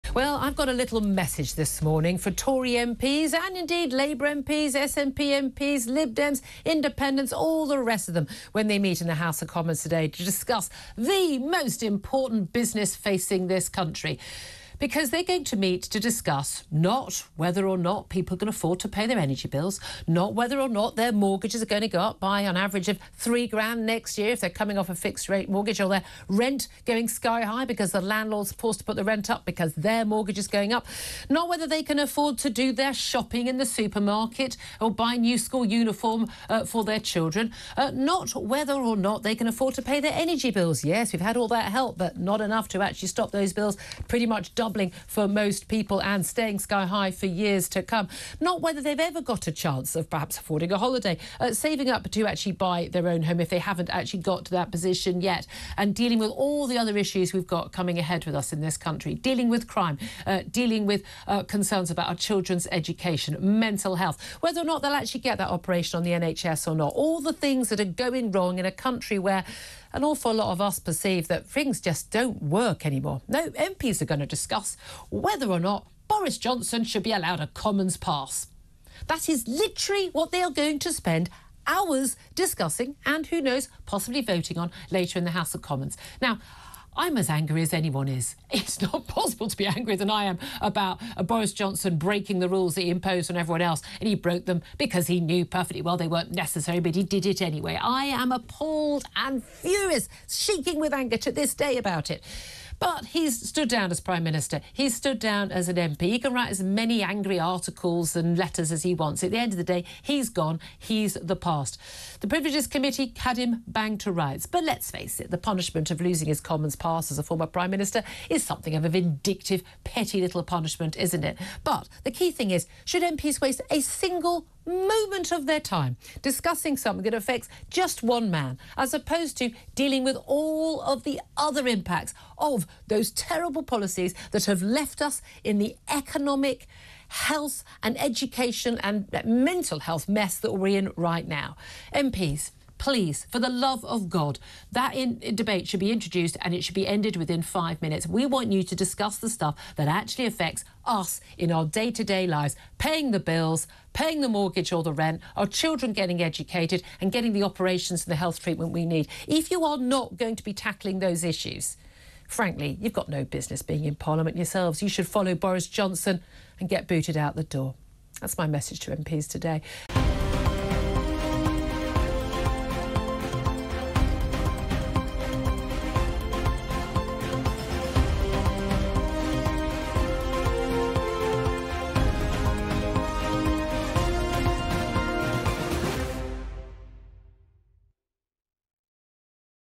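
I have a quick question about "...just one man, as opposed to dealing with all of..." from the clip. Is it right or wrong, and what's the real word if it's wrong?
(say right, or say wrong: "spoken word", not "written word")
right.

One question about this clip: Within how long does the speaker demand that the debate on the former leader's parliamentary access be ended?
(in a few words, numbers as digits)
5 minutes.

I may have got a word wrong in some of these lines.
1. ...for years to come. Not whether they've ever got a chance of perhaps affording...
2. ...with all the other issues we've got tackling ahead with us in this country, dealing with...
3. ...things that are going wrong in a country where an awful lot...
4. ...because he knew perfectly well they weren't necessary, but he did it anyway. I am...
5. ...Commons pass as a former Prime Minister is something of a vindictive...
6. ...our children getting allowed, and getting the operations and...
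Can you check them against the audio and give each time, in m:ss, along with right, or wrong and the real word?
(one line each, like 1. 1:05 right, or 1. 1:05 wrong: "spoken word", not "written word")
1. 0:47 right
2. 0:56 wrong: "coming", not "tackling"
3. 1:07 right
4. 1:34 right
5. 1:56 right
6. 2:35 wrong: "educated", not "allowed".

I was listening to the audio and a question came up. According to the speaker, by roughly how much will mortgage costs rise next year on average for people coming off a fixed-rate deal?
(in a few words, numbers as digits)
3 grand.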